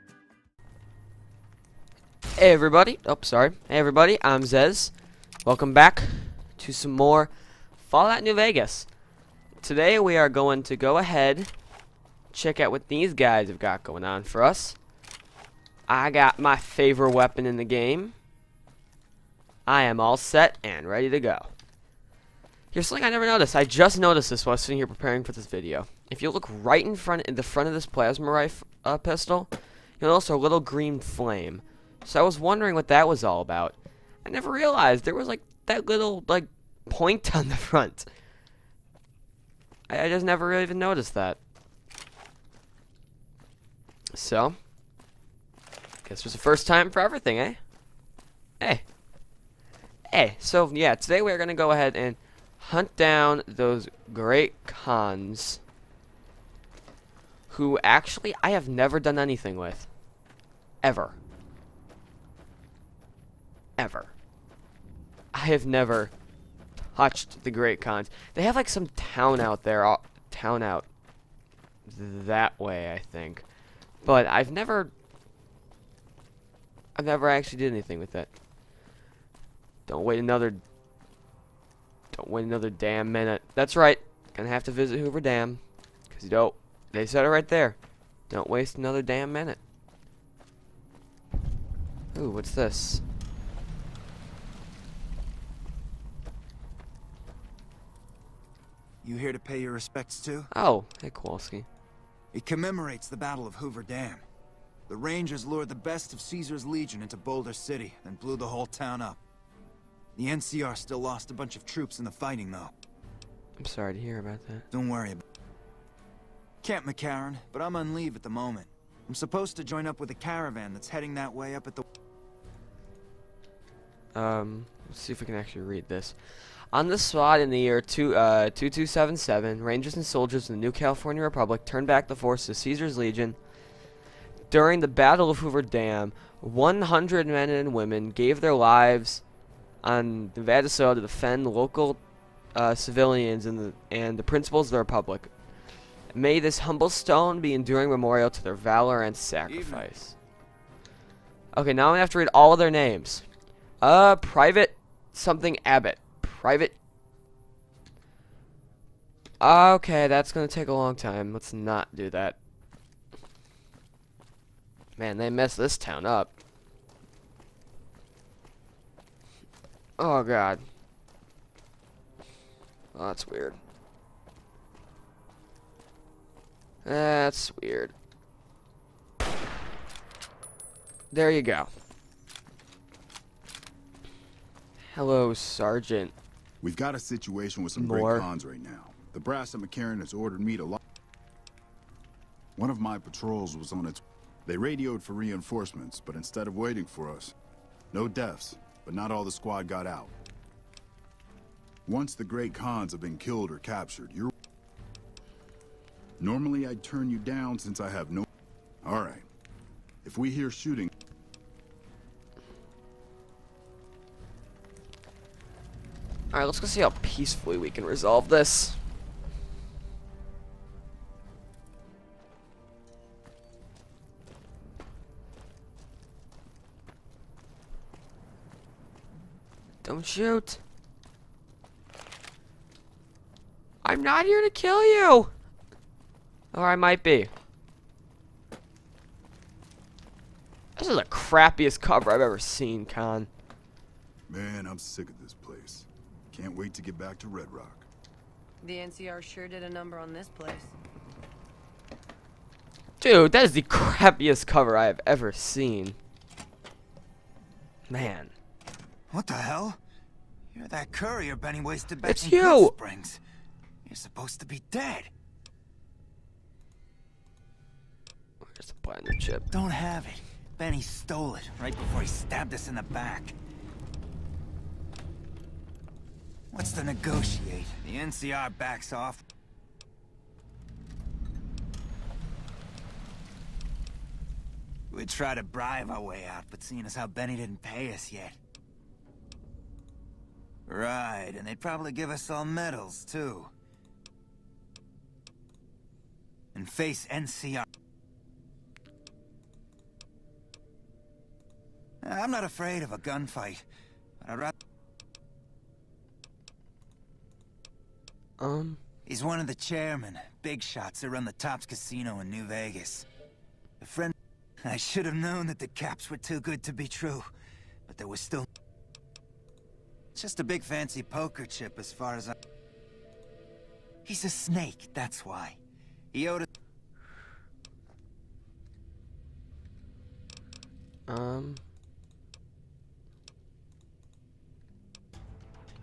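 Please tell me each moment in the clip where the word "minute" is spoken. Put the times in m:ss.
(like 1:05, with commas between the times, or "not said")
1:23, 1:29.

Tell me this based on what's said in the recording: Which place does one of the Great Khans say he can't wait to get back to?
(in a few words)
Red Rock.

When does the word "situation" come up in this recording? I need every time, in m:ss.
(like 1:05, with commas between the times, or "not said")
3:06.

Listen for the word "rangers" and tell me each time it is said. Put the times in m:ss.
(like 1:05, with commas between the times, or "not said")
1:44, 2:09.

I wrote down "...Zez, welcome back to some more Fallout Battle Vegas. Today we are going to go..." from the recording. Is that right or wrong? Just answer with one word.
wrong.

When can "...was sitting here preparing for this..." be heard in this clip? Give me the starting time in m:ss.
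0:24.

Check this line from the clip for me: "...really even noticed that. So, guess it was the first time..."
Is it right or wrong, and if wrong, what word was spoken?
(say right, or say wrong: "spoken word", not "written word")
right.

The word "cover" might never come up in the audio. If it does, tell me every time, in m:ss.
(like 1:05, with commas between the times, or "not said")
4:01, 4:14.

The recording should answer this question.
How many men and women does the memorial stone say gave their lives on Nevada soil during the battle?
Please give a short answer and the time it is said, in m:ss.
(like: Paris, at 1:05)
100, at 2:16.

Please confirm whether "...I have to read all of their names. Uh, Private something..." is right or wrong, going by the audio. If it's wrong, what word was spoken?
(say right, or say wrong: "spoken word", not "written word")
right.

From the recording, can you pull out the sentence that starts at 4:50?
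Right, and they'd probably give us all medals, too.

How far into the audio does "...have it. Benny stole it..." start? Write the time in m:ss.
4:29.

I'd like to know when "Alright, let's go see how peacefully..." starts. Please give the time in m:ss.
3:36.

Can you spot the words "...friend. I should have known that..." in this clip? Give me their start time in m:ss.
5:13.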